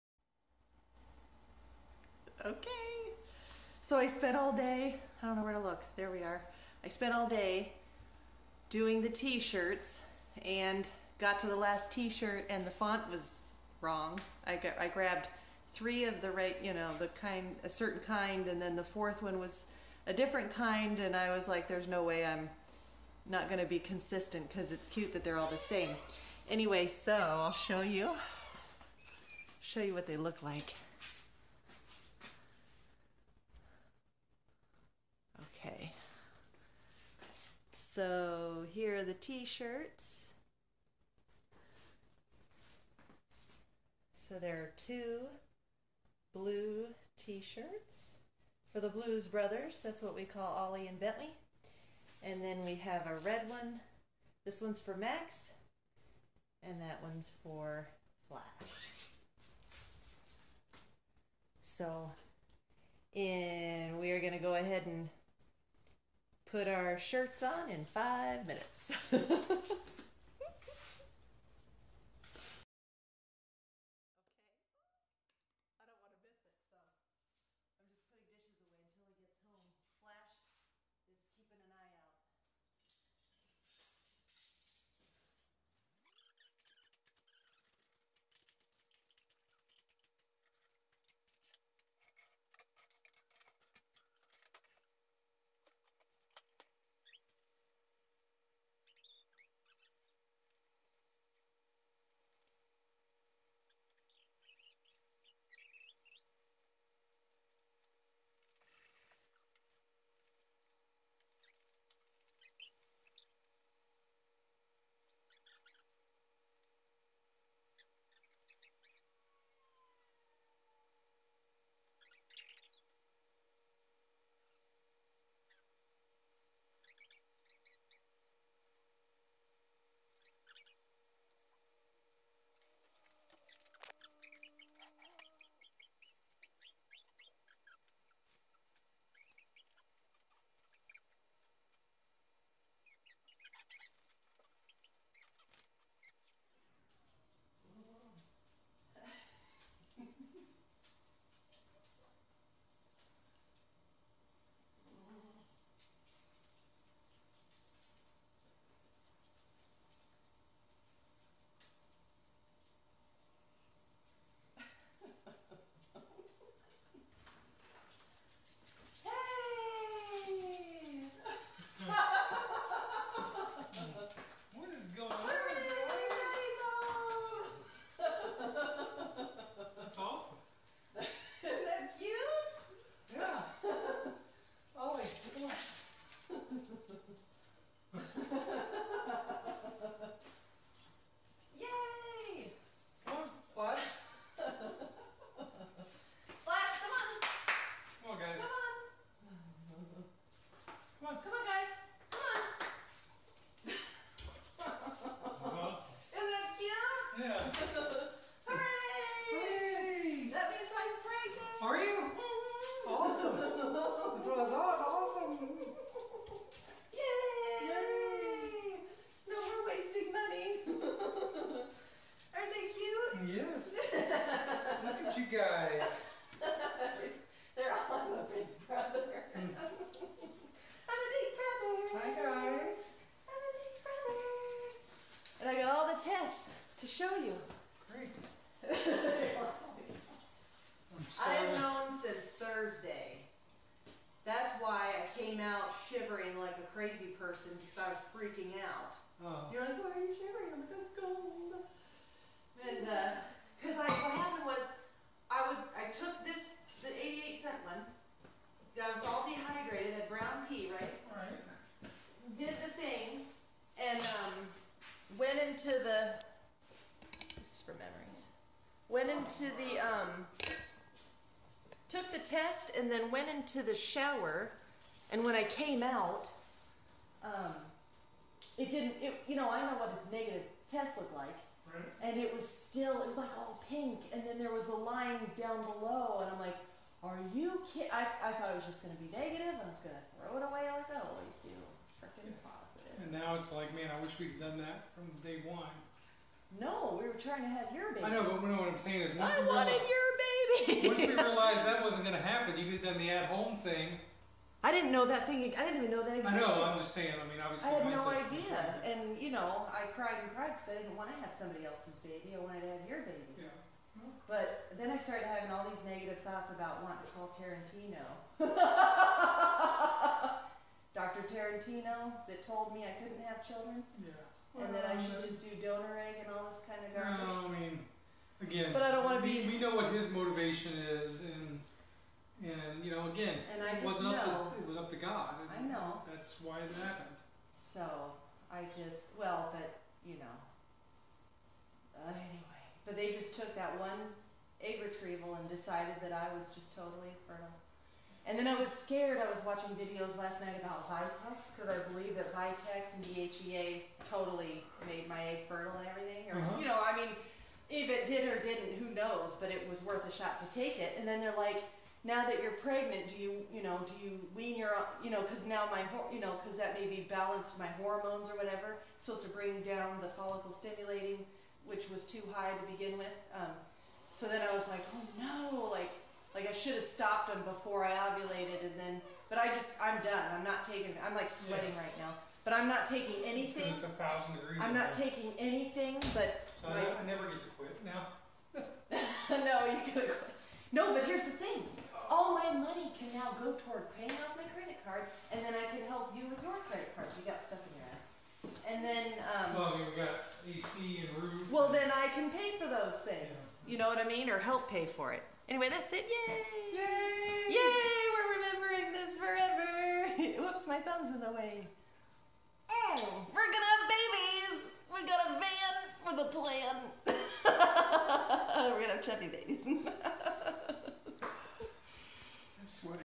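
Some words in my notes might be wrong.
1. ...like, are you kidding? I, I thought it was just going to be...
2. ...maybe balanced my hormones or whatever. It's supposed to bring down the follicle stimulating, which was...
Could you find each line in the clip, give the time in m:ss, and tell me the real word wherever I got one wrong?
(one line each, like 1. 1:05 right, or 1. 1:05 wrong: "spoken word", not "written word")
1. 4:46 right
2. 6:06 right.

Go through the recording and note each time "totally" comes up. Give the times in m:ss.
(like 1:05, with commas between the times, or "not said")
5:46, 5:54.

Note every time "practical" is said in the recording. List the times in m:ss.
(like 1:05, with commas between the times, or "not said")
not said.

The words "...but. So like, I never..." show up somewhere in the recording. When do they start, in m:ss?
6:26.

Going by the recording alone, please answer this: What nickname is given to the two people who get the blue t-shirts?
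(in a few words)
Blues Brothers.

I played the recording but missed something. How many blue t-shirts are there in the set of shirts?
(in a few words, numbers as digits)
2.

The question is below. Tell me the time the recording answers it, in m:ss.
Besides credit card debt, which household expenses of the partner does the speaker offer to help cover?
6:40.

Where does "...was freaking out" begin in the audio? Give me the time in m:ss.
4:07.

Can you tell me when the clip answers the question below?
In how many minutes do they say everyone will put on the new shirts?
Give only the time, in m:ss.
1:07.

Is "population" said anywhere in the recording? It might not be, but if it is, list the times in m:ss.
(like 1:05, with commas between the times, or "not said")
not said.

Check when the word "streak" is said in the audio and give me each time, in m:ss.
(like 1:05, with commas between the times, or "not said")
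not said.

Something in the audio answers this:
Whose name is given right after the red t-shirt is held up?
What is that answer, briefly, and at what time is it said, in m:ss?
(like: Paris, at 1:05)
Max, at 0:54.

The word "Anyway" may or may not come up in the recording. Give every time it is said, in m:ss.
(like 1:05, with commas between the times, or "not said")
0:26, 5:42, 6:45.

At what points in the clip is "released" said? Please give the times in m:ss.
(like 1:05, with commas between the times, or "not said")
not said.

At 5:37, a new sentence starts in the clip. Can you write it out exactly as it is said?
so I just, well, but, you know.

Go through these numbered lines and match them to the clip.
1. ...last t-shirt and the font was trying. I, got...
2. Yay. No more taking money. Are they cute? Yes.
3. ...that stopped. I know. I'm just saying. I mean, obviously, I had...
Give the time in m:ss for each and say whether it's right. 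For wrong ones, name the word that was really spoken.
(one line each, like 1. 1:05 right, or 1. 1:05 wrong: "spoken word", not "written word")
1. 0:11 wrong: "wrong", not "trying"
2. 3:37 wrong: "wasting", not "taking"
3. 5:06 wrong: "existed", not "stopped".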